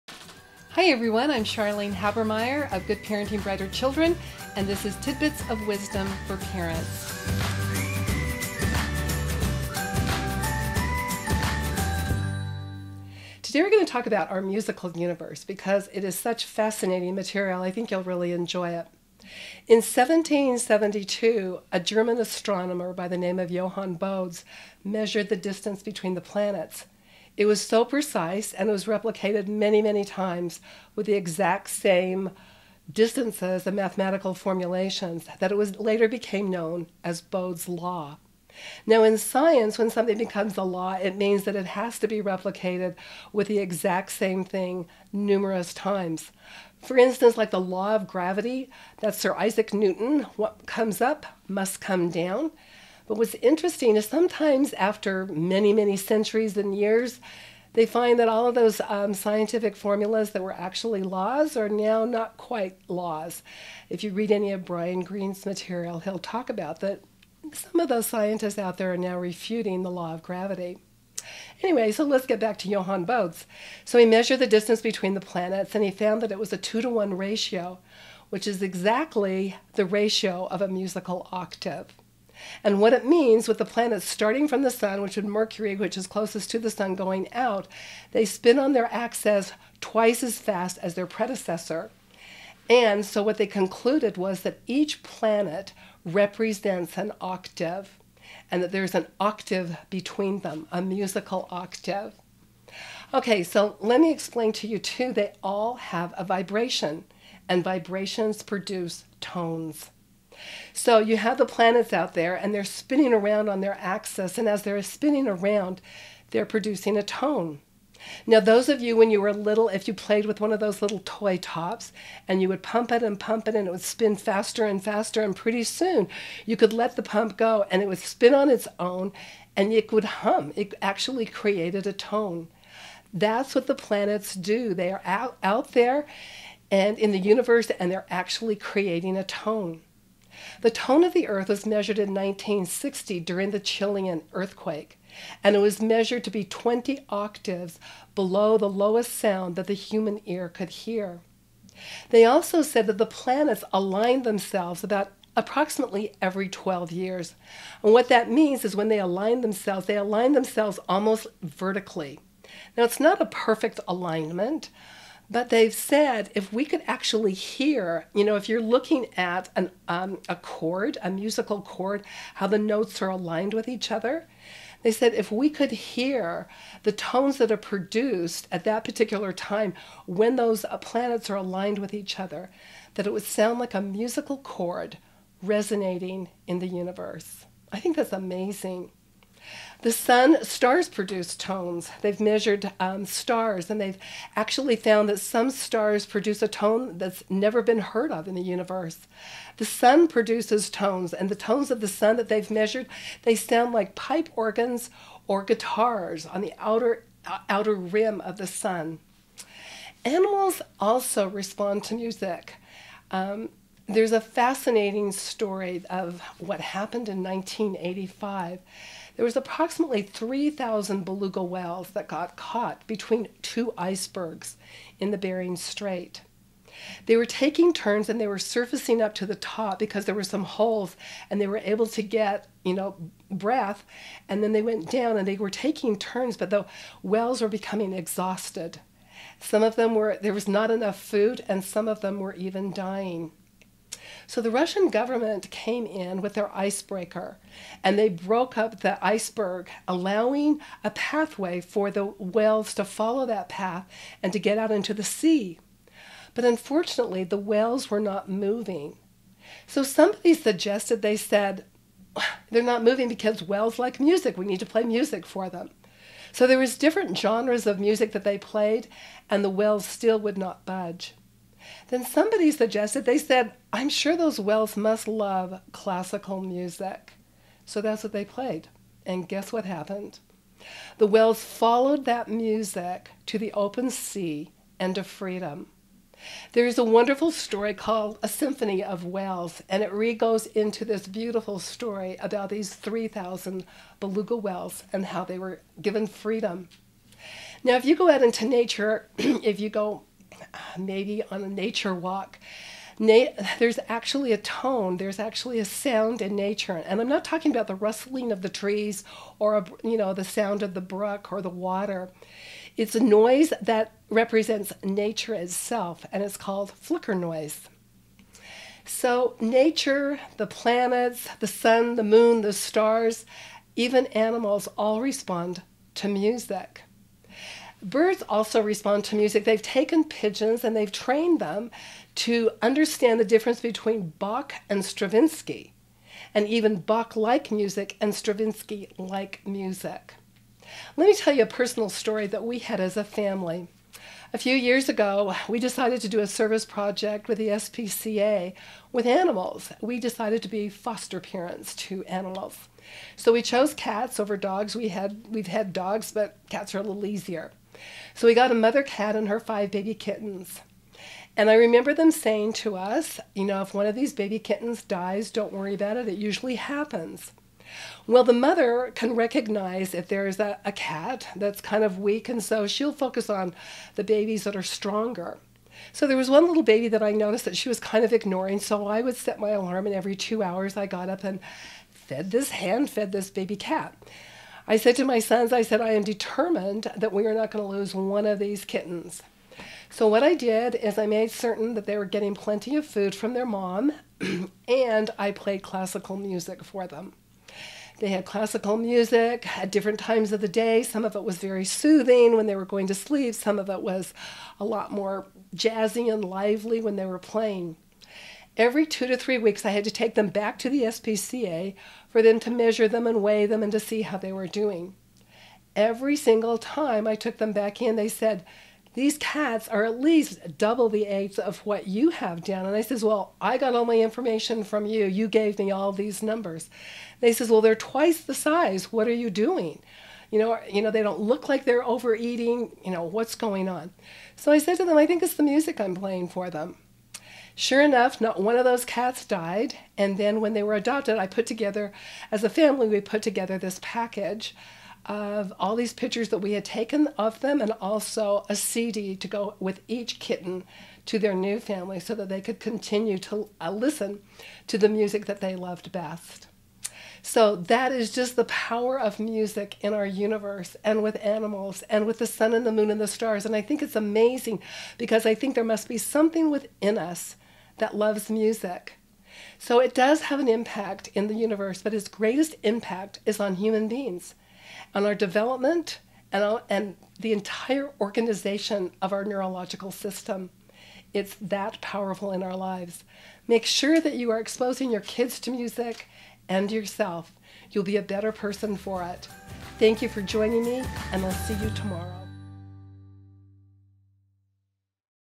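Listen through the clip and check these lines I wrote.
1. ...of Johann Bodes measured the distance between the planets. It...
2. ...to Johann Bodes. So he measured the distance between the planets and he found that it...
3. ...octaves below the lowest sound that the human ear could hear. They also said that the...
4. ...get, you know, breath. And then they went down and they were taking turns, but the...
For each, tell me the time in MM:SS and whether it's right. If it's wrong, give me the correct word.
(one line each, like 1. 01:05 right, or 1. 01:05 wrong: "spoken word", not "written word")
1. 00:23 right
2. 01:12 right
3. 02:27 right
4. 03:52 right.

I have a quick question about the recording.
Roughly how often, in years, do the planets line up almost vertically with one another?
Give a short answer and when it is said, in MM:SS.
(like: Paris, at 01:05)
12, at 02:36.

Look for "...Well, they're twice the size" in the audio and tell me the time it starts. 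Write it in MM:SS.
07:07.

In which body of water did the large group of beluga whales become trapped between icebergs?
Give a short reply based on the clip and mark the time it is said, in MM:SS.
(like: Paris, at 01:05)
Bering Strait, at 03:45.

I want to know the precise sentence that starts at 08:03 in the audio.
Make sure that you are exposing your kids to music and yourself.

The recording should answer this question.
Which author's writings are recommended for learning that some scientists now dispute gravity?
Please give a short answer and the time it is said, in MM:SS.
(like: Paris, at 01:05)
Brian Greene, at 01:04.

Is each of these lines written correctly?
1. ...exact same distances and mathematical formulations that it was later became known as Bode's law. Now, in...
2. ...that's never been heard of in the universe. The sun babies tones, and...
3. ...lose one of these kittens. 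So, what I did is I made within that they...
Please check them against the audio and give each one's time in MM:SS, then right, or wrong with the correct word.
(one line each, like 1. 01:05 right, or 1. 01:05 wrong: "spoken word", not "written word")
1. 00:31 right
2. 03:16 wrong: "produces", not "babies"
3. 06:27 wrong: "certain", not "within".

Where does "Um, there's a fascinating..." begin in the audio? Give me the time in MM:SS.
03:33.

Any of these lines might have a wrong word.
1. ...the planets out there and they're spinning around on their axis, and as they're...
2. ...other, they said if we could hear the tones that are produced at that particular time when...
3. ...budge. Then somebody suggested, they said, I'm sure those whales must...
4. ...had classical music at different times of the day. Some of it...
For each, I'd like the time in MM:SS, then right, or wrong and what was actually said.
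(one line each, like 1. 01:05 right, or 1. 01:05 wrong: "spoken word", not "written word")
1. 01:51 right
2. 02:53 right
3. 04:30 right
4. 06:38 right.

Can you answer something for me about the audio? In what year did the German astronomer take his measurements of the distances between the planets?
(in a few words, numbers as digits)
1772.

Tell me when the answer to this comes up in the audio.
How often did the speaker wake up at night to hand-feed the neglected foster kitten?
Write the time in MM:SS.
06:19.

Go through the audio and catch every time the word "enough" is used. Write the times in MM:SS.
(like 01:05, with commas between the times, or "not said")
04:00, 07:17.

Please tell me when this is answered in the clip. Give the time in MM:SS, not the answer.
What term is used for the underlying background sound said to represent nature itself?
05:16.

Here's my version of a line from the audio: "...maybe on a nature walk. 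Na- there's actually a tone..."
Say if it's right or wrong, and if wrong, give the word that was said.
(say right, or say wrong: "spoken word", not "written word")
right.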